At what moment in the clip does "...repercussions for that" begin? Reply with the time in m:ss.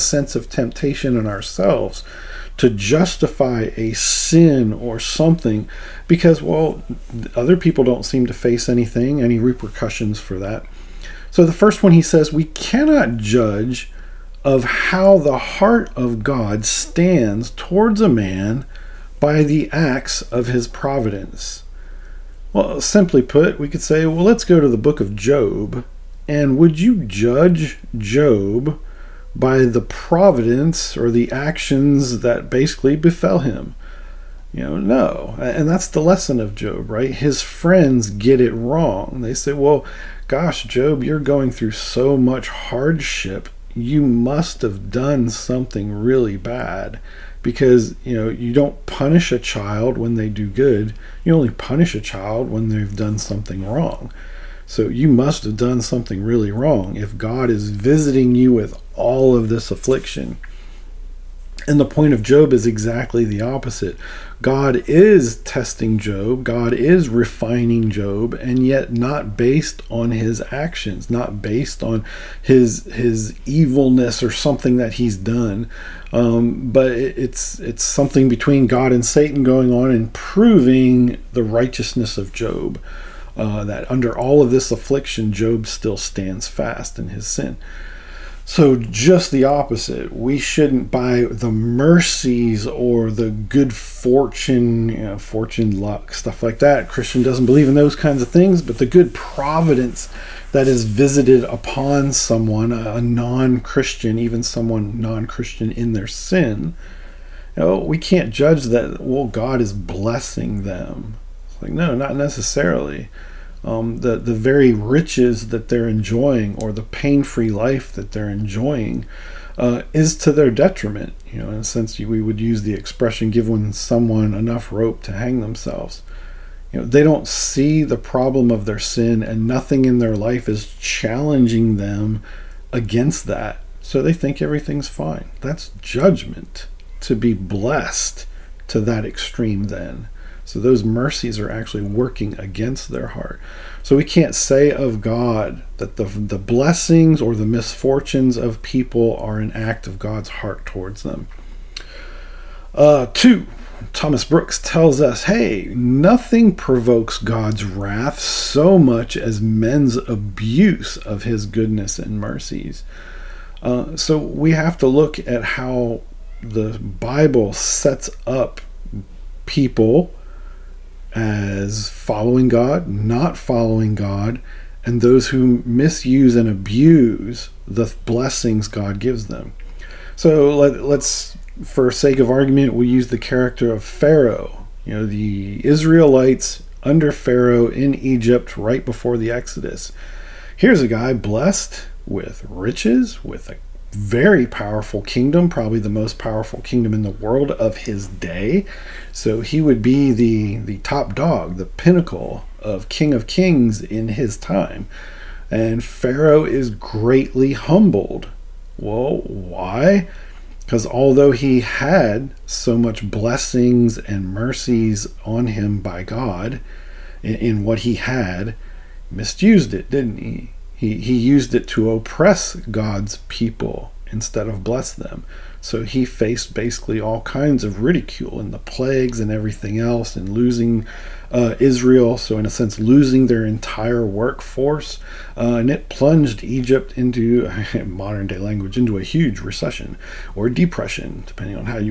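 0:09.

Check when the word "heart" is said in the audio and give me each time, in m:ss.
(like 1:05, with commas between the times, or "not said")
0:15, 2:23, 2:30.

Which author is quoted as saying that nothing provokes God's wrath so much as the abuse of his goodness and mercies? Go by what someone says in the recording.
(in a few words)
Thomas Brooks.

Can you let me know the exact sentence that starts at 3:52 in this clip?
So, in a sense, losing their entire workforce.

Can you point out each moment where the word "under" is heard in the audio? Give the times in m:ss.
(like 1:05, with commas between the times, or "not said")
1:23, 3:06.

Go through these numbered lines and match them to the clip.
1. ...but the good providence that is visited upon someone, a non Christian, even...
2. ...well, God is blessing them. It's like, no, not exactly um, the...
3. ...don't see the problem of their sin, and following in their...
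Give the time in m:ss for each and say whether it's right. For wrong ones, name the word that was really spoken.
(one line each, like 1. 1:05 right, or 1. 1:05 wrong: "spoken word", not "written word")
1. 1:38 right
2. 1:49 wrong: "necessarily", not "exactly"
3. 2:07 wrong: "nothing", not "following".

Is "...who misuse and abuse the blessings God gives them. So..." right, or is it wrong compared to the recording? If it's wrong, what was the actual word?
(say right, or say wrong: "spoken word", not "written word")
right.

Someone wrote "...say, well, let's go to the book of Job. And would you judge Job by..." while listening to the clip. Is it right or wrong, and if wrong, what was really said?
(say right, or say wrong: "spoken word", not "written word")
right.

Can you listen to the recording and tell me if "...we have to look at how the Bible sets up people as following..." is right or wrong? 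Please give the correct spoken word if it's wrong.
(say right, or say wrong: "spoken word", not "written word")
right.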